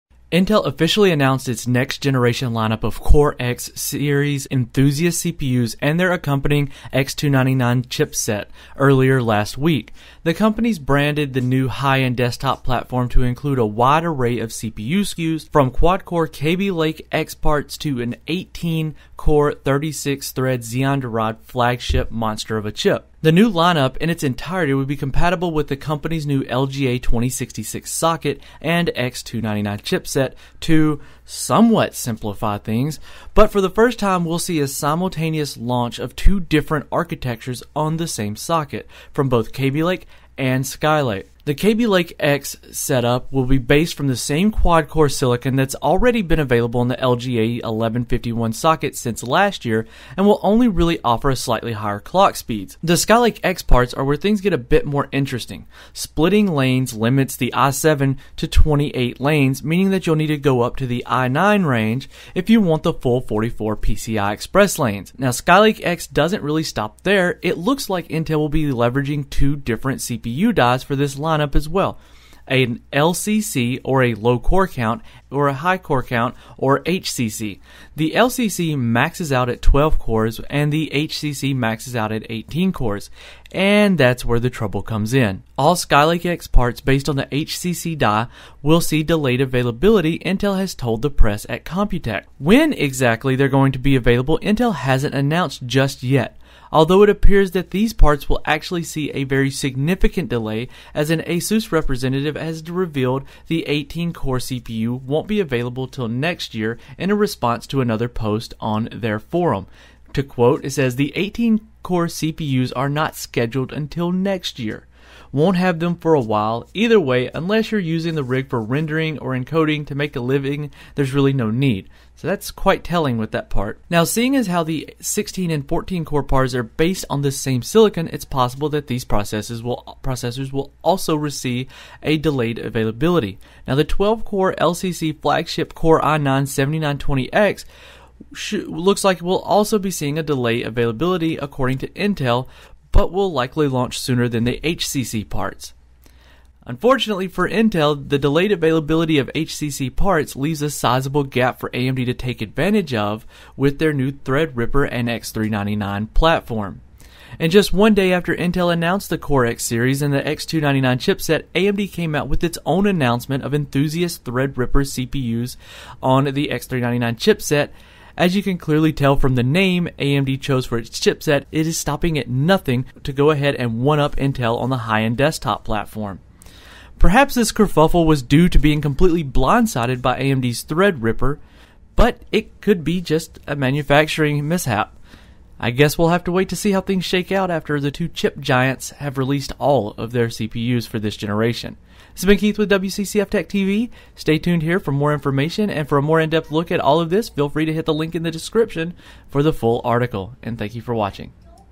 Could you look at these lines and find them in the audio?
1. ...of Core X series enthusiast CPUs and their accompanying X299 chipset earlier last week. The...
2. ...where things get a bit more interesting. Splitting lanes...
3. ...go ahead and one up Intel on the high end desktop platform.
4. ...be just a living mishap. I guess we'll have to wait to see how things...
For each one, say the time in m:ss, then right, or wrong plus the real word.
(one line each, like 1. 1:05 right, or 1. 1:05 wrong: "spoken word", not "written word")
1. 0:02 right
2. 0:54 right
3. 2:53 right
4. 3:02 wrong: "manufacturing", not "living".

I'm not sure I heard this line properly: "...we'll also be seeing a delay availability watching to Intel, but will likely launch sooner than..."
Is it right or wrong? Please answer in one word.
wrong.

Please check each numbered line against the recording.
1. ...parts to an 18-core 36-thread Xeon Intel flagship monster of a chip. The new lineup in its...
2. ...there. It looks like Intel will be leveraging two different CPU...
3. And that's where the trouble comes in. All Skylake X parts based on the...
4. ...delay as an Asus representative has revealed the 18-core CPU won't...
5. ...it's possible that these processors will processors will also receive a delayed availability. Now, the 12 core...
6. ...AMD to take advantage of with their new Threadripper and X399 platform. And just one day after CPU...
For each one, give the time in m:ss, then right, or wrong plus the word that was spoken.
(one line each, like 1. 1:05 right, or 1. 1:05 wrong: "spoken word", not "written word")
1. 0:17 wrong: "Derived", not "Intel"
2. 1:07 right
3. 1:23 right
4. 1:40 right
5. 2:08 right
6. 2:31 wrong: "Intel", not "CPU".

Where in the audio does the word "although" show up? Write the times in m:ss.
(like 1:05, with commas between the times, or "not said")
1:36.